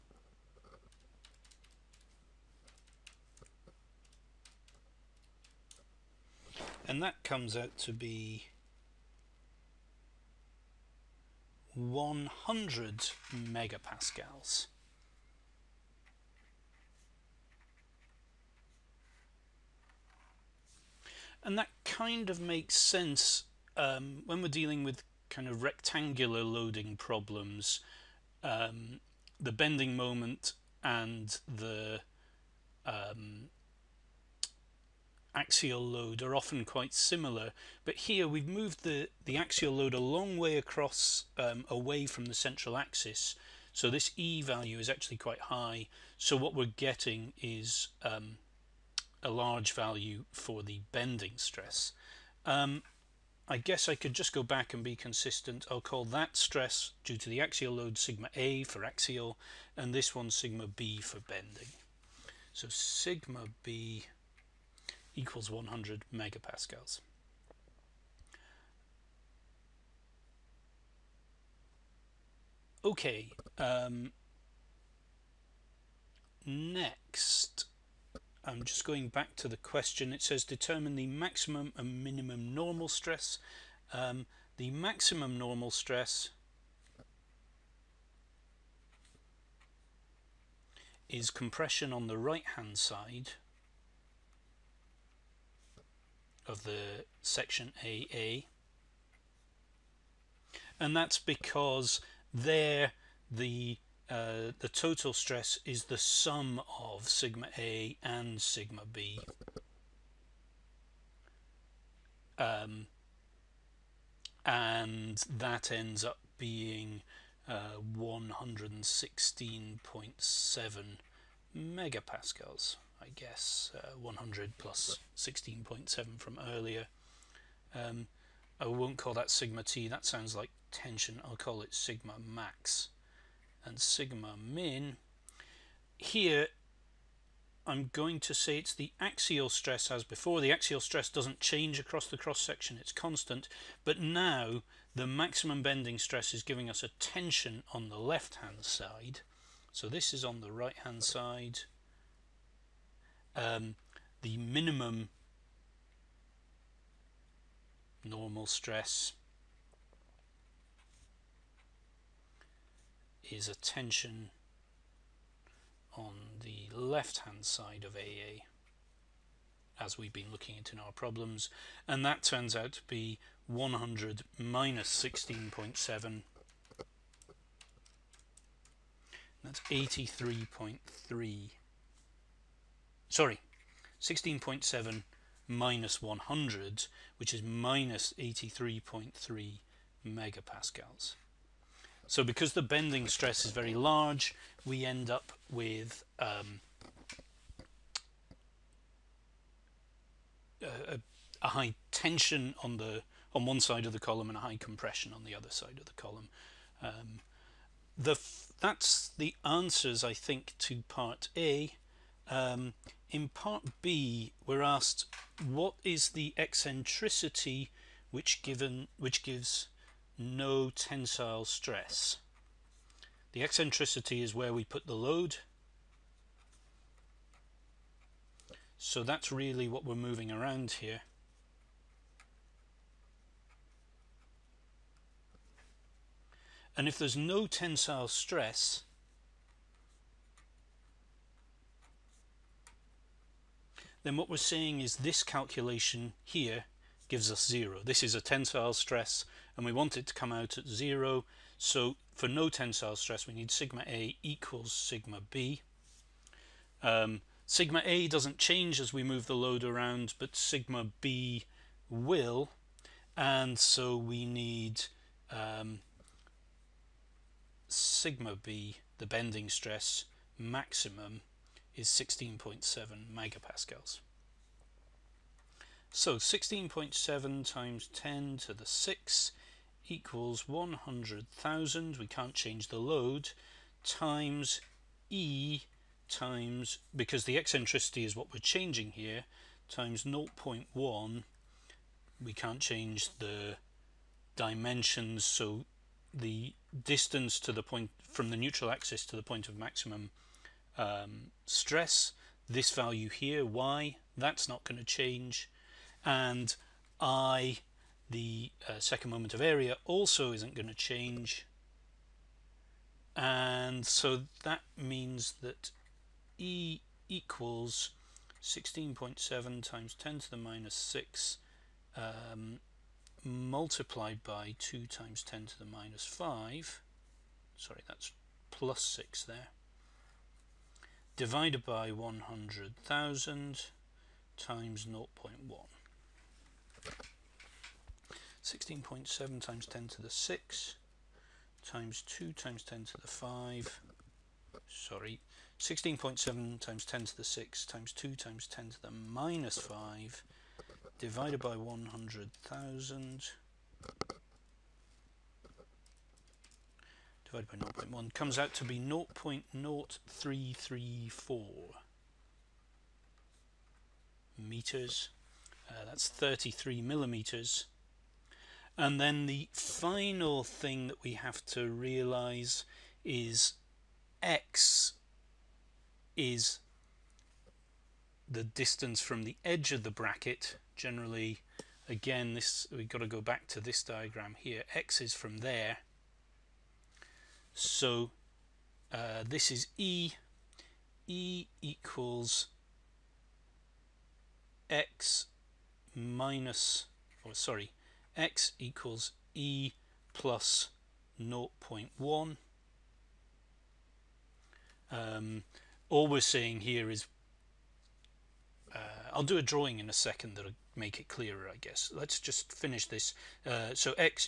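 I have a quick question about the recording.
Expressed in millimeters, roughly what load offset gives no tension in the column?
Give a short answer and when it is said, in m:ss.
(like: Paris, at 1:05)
33 millimeters, at 6:06.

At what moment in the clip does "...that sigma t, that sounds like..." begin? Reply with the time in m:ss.
2:09.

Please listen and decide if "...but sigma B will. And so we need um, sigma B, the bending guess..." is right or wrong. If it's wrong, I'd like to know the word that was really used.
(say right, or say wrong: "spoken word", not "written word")
wrong: "stress", not "guess".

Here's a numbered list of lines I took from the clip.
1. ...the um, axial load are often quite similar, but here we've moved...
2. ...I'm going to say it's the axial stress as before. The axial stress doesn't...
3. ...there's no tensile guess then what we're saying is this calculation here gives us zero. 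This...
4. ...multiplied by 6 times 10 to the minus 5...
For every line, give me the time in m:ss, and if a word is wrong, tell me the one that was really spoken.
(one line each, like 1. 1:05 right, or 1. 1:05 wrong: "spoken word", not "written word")
1. 0:31 right
2. 2:17 right
3. 3:56 wrong: "stress", not "guess"
4. 5:23 wrong: "2", not "6".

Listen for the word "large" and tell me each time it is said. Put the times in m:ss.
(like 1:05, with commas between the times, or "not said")
0:49, 3:13.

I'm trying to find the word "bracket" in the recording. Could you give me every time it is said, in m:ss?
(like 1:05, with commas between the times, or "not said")
6:19.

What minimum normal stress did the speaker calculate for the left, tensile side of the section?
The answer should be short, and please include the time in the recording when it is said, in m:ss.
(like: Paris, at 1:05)
-83.3 megapascals, at 3:07.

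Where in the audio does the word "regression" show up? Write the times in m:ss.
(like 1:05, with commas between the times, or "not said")
not said.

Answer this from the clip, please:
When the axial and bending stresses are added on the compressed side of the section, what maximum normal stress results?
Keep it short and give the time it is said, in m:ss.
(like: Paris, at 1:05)
116.7 megapascals, at 1:57.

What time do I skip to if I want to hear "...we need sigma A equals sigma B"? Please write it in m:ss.
4:13.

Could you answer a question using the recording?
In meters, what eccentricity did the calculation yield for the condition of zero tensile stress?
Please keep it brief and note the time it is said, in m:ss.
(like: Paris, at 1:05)
0.0334 meters, at 5:58.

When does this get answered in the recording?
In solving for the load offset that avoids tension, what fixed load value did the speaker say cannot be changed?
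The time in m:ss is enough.
4:40.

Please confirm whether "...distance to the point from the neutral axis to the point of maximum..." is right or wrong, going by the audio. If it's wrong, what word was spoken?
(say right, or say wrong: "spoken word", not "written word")
right.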